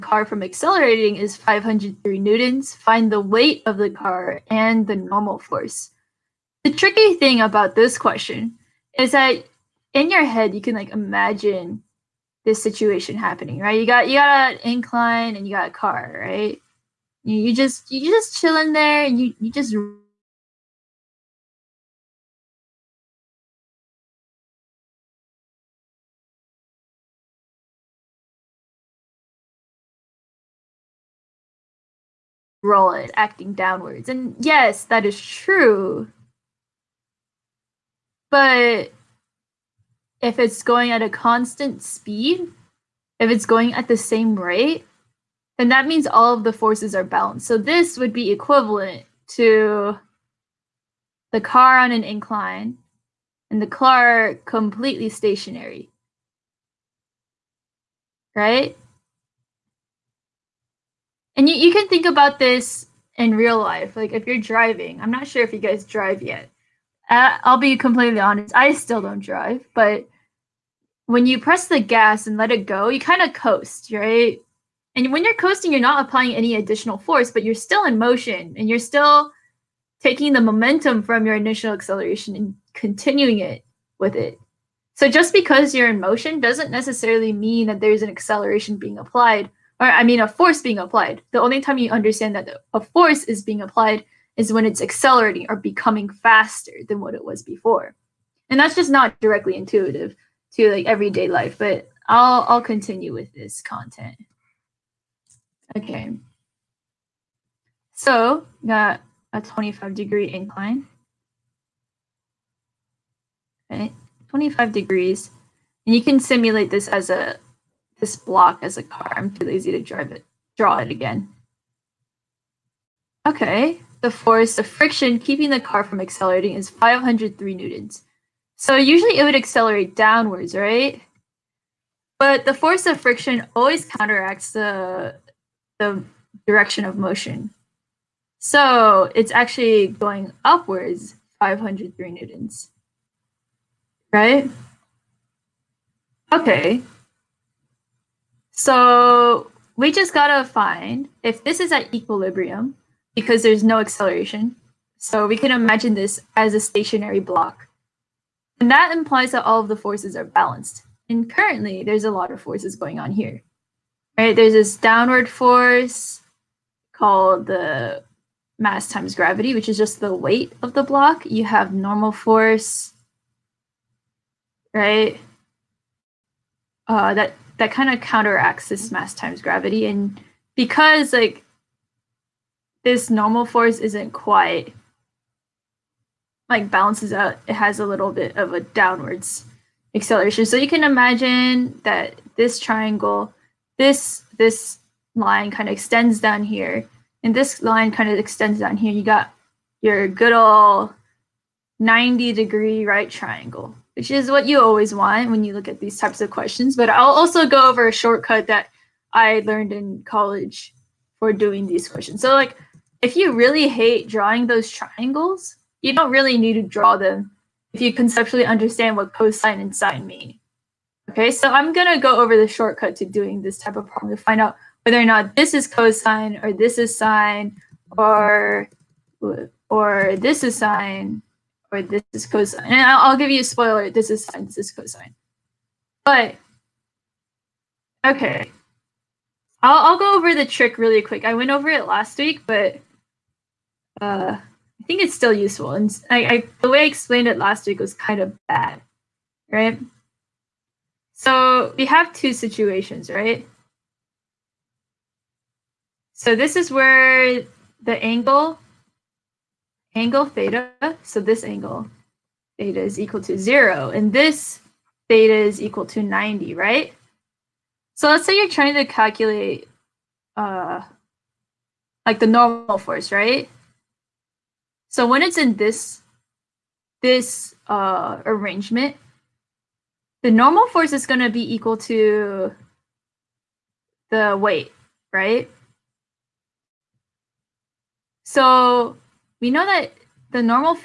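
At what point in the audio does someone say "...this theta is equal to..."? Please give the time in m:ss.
4:24.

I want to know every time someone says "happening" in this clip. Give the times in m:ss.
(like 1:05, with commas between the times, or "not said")
0:13.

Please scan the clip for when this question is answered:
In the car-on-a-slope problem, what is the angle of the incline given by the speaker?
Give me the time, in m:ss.
1:54.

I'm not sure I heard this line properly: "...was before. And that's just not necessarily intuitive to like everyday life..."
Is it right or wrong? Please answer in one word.
wrong.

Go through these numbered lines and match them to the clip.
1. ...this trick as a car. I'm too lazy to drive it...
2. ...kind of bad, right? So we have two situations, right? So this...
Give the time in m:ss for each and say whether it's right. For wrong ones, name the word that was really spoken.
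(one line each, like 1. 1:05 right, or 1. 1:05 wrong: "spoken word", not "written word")
1. 1:58 wrong: "block", not "trick"
2. 4:07 right.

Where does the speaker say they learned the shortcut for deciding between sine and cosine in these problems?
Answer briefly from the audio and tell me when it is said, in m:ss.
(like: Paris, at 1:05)
College, at 3:30.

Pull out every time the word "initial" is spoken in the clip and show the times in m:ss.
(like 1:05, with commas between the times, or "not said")
1:21.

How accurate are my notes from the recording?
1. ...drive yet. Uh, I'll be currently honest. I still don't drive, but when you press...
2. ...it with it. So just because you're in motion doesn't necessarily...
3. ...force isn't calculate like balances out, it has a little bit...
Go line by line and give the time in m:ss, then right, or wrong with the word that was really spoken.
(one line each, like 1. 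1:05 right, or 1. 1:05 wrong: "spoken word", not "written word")
1. 1:05 wrong: "completely", not "currently"
2. 1:23 right
3. 3:03 wrong: "quite", not "calculate".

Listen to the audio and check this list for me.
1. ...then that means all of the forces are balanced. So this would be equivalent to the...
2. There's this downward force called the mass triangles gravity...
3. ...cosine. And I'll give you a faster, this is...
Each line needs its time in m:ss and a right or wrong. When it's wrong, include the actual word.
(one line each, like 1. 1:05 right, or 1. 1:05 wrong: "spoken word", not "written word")
1. 0:45 right
2. 2:44 wrong: "times", not "triangles"
3. 3:52 wrong: "spoiler", not "faster".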